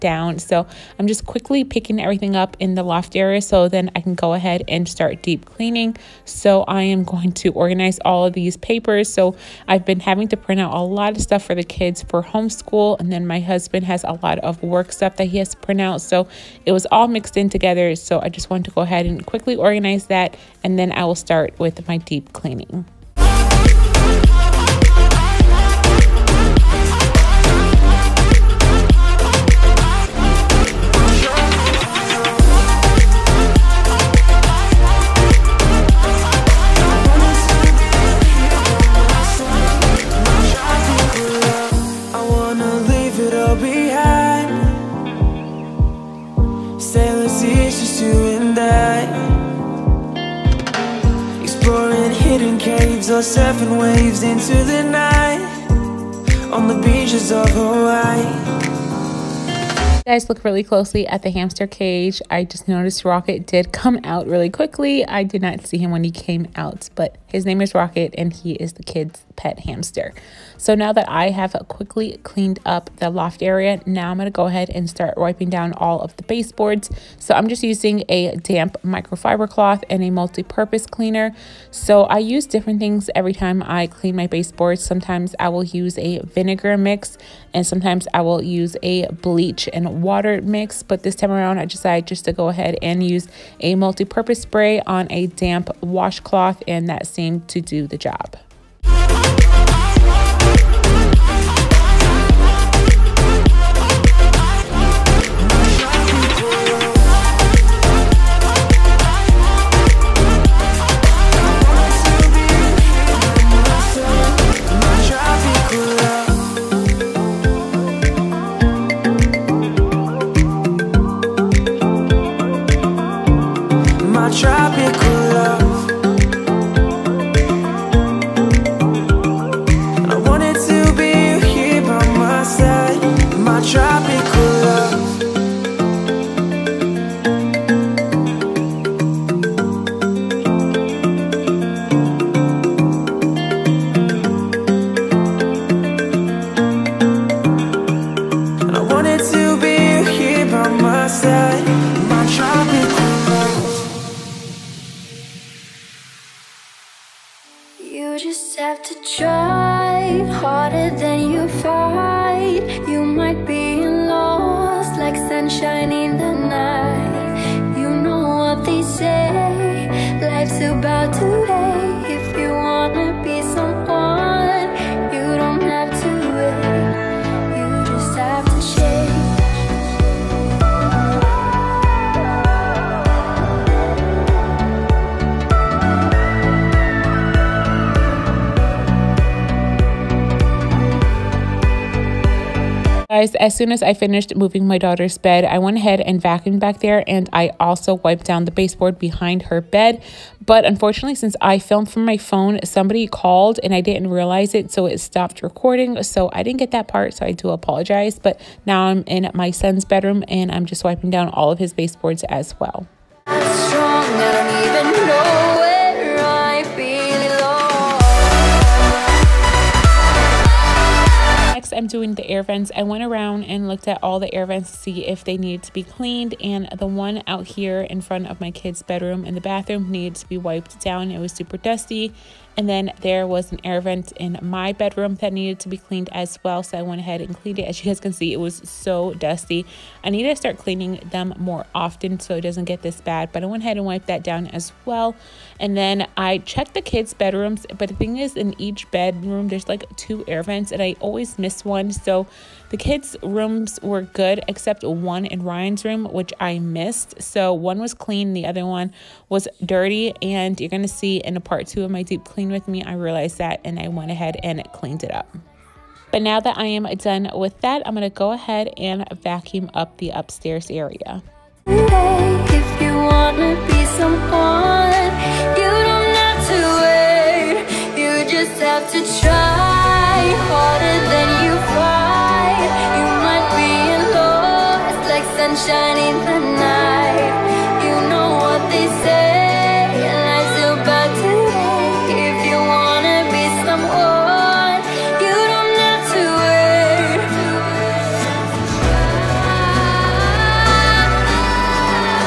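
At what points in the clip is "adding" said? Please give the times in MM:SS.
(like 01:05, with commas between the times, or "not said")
not said.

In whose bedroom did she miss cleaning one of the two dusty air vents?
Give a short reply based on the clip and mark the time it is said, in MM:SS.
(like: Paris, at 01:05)
Ryan, at 04:15.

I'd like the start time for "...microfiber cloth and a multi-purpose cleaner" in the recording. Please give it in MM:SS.
01:18.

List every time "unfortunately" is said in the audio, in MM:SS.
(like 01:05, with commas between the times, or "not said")
03:20.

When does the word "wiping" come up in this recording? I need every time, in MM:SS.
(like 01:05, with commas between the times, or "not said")
01:15, 03:30.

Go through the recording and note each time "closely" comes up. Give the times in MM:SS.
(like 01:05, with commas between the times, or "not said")
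01:00.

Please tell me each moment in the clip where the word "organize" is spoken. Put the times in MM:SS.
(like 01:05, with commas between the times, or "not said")
00:07, 00:19.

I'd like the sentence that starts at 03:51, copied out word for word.
It was super dusty and then there was an air vent in my bedroom that needed to be cleaned as well.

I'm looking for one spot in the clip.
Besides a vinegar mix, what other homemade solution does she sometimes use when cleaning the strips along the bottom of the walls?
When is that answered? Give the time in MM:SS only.
01:29.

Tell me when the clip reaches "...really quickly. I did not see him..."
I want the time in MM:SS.
01:04.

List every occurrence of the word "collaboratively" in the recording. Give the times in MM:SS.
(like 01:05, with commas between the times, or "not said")
not said.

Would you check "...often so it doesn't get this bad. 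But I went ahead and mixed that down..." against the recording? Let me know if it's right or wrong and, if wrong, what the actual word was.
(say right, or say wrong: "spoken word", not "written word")
wrong: "wiped", not "mixed".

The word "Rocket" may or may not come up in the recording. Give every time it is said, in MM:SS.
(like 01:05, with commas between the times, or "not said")
01:03, 01:07.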